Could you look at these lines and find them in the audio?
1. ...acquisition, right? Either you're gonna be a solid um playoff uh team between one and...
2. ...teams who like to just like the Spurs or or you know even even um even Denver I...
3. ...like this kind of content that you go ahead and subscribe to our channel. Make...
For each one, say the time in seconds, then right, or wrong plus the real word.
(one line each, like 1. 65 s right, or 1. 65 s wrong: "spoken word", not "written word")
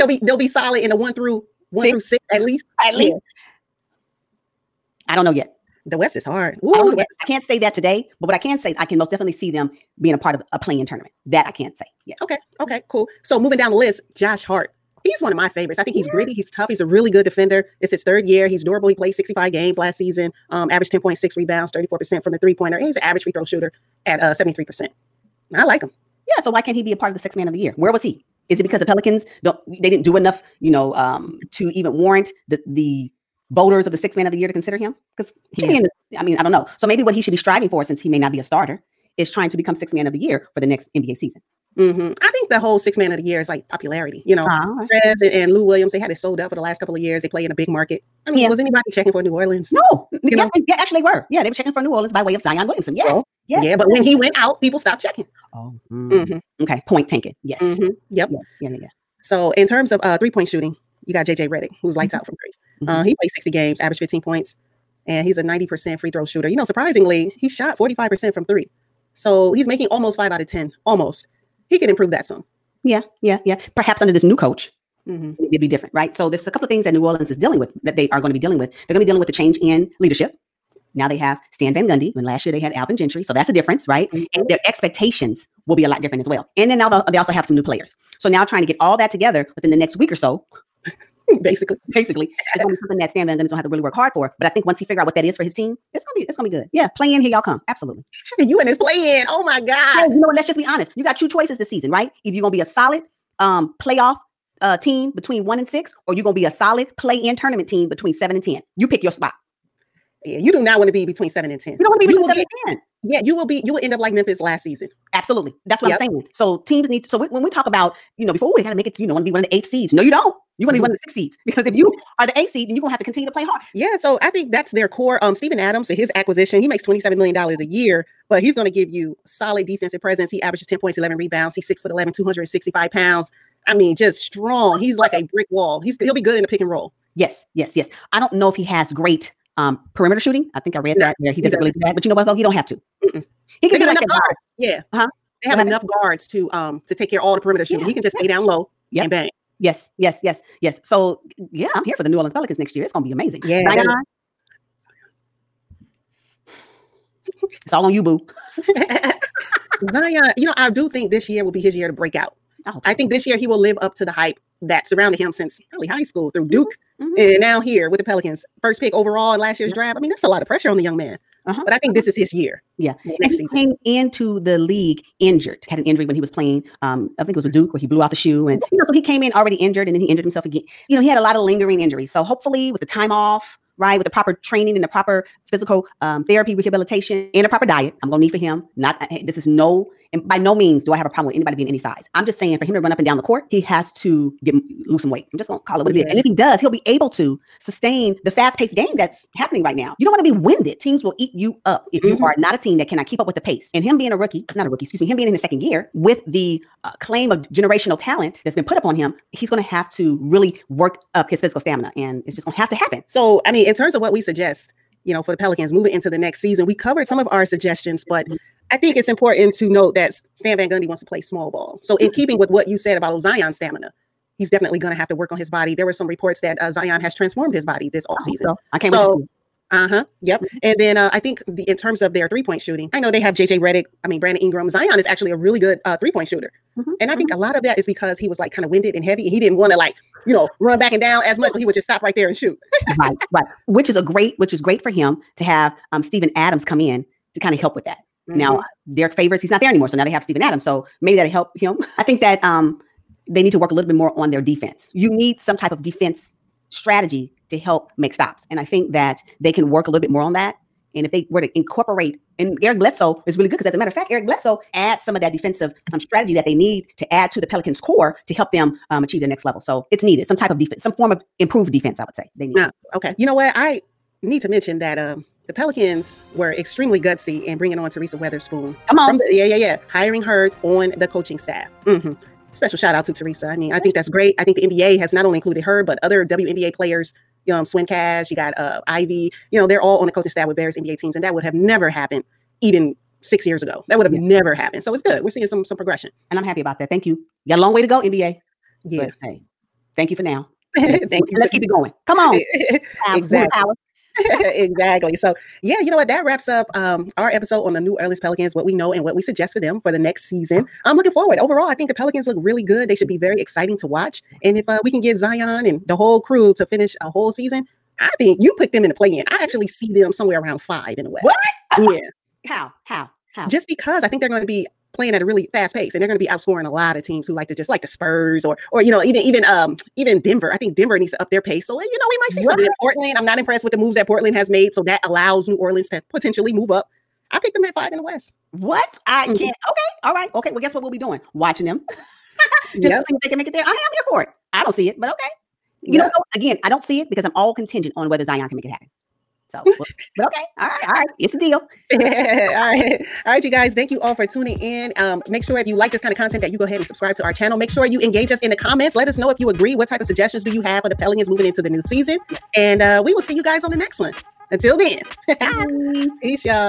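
1. 101 s wrong: "season", not "acquisition"
2. 327 s right
3. 355 s right.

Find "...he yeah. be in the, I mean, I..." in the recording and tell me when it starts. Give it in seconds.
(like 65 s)
35 s.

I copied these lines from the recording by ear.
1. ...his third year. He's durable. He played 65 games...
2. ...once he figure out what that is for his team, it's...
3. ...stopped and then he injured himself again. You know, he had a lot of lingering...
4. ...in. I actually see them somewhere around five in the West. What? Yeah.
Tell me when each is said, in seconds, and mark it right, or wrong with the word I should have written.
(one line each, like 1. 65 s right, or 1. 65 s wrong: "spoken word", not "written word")
1. 17 s right
2. 94 s right
3. 179 s wrong: "injured", not "stopped"
4. 319 s right.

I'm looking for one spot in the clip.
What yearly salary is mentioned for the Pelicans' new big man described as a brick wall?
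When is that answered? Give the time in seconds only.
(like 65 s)
126 s.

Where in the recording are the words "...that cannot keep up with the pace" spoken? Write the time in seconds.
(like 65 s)
202 s.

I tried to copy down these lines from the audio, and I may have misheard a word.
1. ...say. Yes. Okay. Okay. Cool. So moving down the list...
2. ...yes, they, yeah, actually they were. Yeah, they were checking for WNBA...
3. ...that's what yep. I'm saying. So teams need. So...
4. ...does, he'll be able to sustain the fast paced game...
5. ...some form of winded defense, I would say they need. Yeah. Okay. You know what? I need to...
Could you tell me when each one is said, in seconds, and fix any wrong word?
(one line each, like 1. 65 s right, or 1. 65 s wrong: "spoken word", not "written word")
1. 11 s right
2. 50 s wrong: "New", not "WNBA"
3. 115 s right
4. 196 s right
5. 270 s wrong: "improved", not "winded".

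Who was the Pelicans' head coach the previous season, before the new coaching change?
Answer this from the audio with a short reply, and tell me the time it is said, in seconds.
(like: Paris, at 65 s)
Alvin Gentry, at 82 s.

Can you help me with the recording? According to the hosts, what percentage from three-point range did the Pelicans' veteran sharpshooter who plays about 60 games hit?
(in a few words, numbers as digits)
45%.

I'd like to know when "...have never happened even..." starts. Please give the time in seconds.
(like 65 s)
291 s.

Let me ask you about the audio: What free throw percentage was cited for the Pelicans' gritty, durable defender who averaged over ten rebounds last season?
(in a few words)
73%.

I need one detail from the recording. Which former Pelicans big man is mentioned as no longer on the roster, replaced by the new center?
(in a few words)
Derrick Favors.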